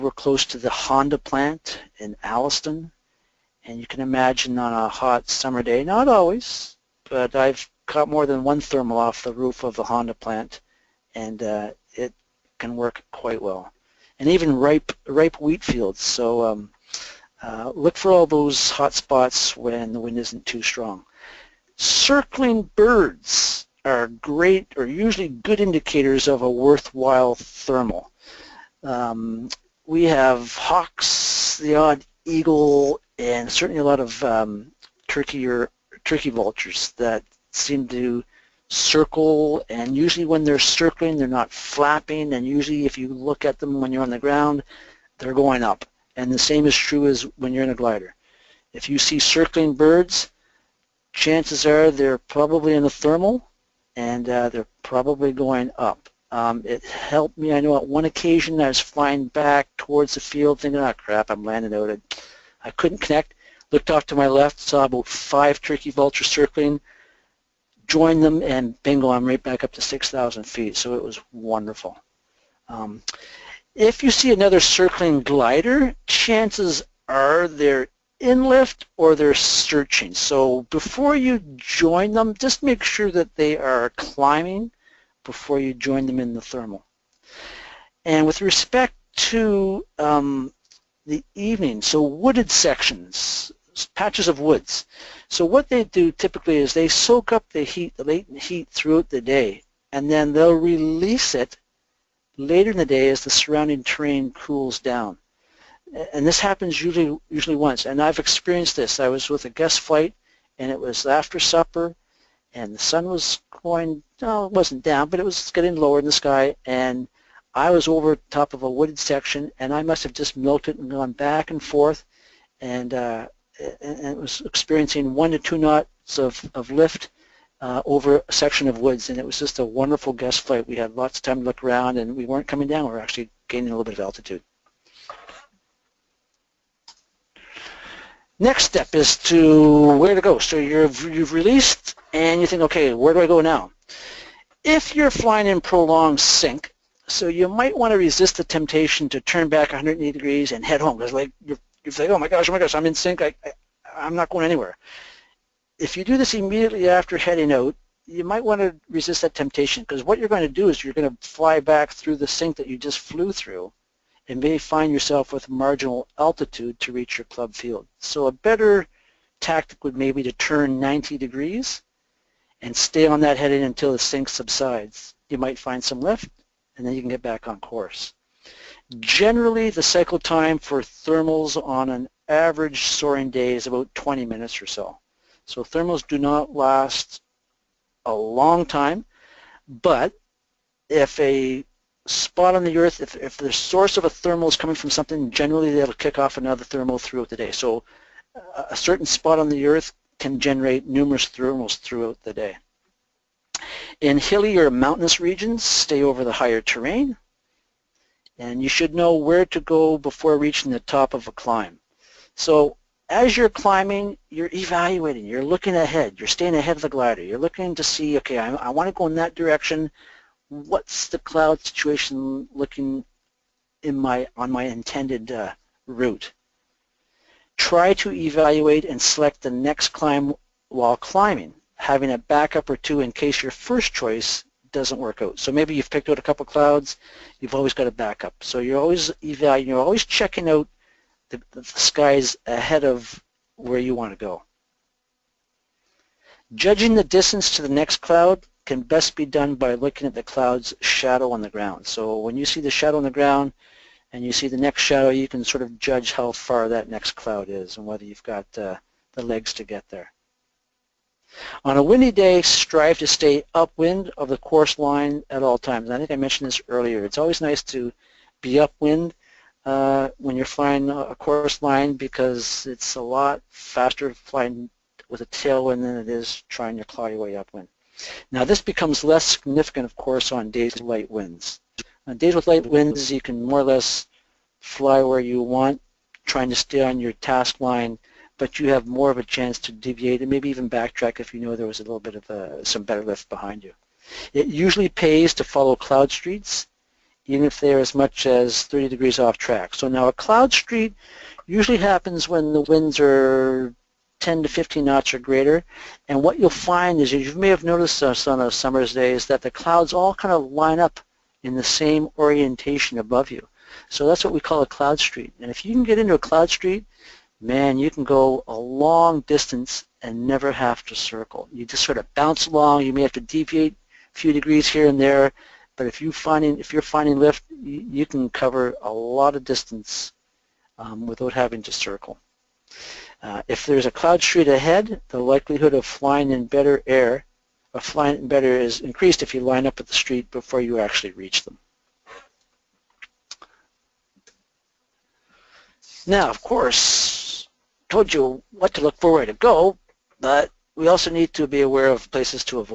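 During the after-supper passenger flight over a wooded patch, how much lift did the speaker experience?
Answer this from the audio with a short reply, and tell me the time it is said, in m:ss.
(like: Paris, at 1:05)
1 to 2 knots, at 2:05.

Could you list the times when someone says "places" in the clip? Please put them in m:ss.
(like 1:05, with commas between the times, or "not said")
5:52.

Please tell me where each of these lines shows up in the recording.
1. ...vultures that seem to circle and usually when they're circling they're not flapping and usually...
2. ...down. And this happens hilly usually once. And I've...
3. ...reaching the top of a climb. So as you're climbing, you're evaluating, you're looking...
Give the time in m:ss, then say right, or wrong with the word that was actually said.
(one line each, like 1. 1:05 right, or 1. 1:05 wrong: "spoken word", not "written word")
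1. 0:36 right
2. 1:44 wrong: "usually", not "hilly"
3. 3:30 right.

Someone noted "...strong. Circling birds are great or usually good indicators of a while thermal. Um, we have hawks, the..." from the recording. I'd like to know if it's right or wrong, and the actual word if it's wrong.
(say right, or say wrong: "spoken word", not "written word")
wrong: "worthwhile", not "while".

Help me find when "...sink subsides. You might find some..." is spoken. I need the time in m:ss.
2:53.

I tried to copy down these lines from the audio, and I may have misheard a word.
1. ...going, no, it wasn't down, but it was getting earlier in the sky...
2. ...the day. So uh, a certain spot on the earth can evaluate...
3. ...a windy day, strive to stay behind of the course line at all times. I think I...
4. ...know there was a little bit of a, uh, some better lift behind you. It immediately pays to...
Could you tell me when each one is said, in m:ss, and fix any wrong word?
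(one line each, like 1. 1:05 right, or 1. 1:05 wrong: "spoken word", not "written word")
1. 1:53 wrong: "lower", not "earlier"
2. 3:17 wrong: "generate", not "evaluate"
3. 4:21 wrong: "upwind", not "behind"
4. 4:51 wrong: "usually", not "immediately".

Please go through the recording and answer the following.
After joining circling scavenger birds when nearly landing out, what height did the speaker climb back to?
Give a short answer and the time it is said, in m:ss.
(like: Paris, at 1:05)
6,000 feet, at 1:09.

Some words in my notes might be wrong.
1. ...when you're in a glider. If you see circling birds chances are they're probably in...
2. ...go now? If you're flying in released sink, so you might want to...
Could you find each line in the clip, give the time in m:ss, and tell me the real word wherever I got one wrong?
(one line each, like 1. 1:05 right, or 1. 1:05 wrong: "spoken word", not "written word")
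1. 0:47 right
2. 2:23 wrong: "prolonged", not "released".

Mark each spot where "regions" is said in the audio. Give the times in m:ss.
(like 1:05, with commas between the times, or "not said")
3:25.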